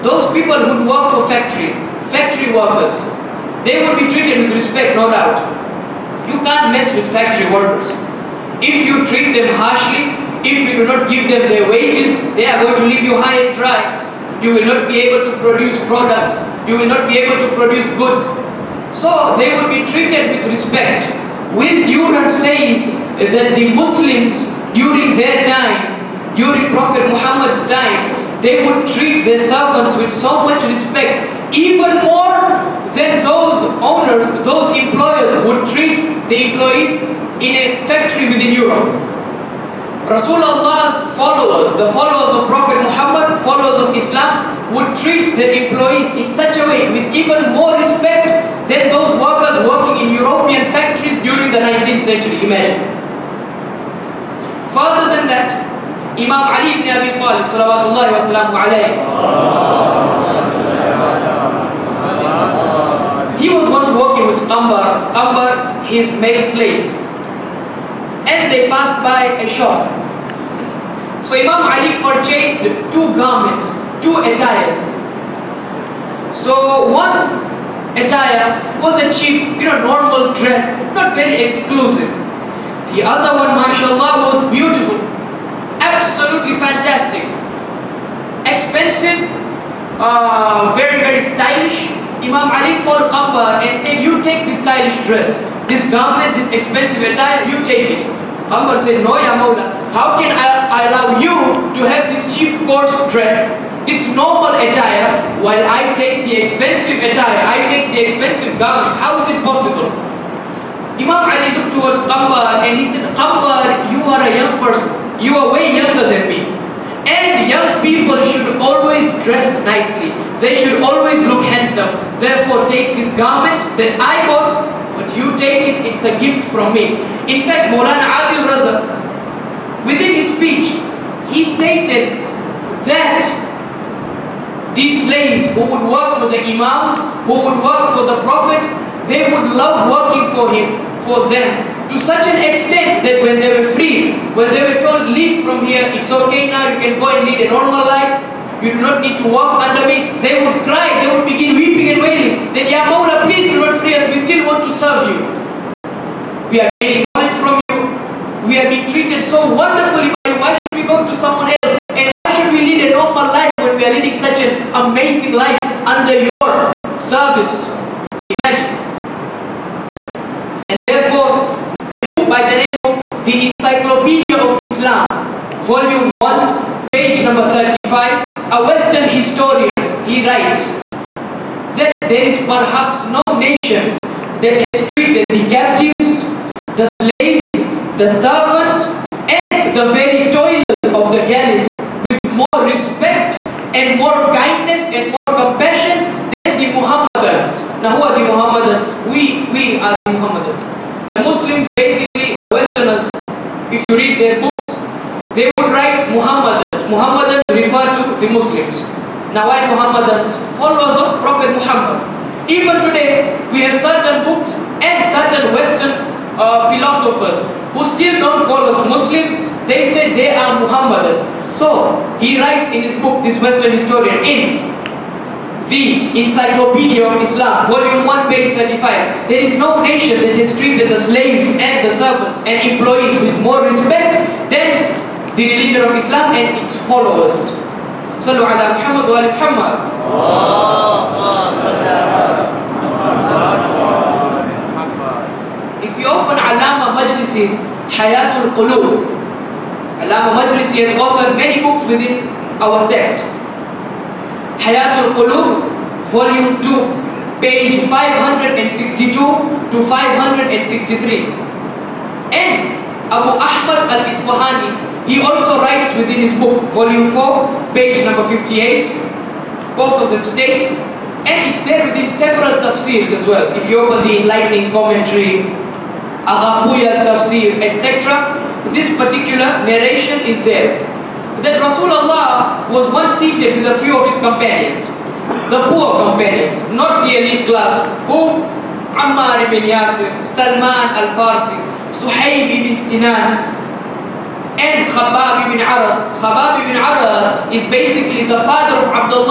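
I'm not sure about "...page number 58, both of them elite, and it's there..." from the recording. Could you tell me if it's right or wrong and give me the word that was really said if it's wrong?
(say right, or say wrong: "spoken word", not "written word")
wrong: "state", not "elite".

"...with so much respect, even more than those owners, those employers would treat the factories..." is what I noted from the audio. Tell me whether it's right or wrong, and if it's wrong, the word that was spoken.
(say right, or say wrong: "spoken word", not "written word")
wrong: "employees", not "factories".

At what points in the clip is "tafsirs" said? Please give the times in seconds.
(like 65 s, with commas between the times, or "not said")
272 s, 276 s.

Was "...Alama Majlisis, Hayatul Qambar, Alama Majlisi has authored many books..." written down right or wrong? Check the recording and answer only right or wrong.
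wrong.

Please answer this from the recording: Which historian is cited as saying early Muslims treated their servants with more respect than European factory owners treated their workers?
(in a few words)
Will Durant.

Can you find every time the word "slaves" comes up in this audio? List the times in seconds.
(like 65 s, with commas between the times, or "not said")
66 s, 135 s, 186 s, 230 s.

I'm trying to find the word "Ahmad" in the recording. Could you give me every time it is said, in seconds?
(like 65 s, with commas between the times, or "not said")
263 s.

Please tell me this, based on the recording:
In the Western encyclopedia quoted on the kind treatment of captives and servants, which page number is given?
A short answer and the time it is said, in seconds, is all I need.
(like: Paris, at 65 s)
35, at 176 s.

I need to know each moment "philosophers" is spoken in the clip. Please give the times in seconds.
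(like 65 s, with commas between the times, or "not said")
216 s.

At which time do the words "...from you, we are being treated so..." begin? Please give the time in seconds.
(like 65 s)
157 s.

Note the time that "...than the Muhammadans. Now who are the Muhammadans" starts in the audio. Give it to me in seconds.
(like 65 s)
196 s.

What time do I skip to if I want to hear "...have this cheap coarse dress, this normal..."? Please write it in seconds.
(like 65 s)
101 s.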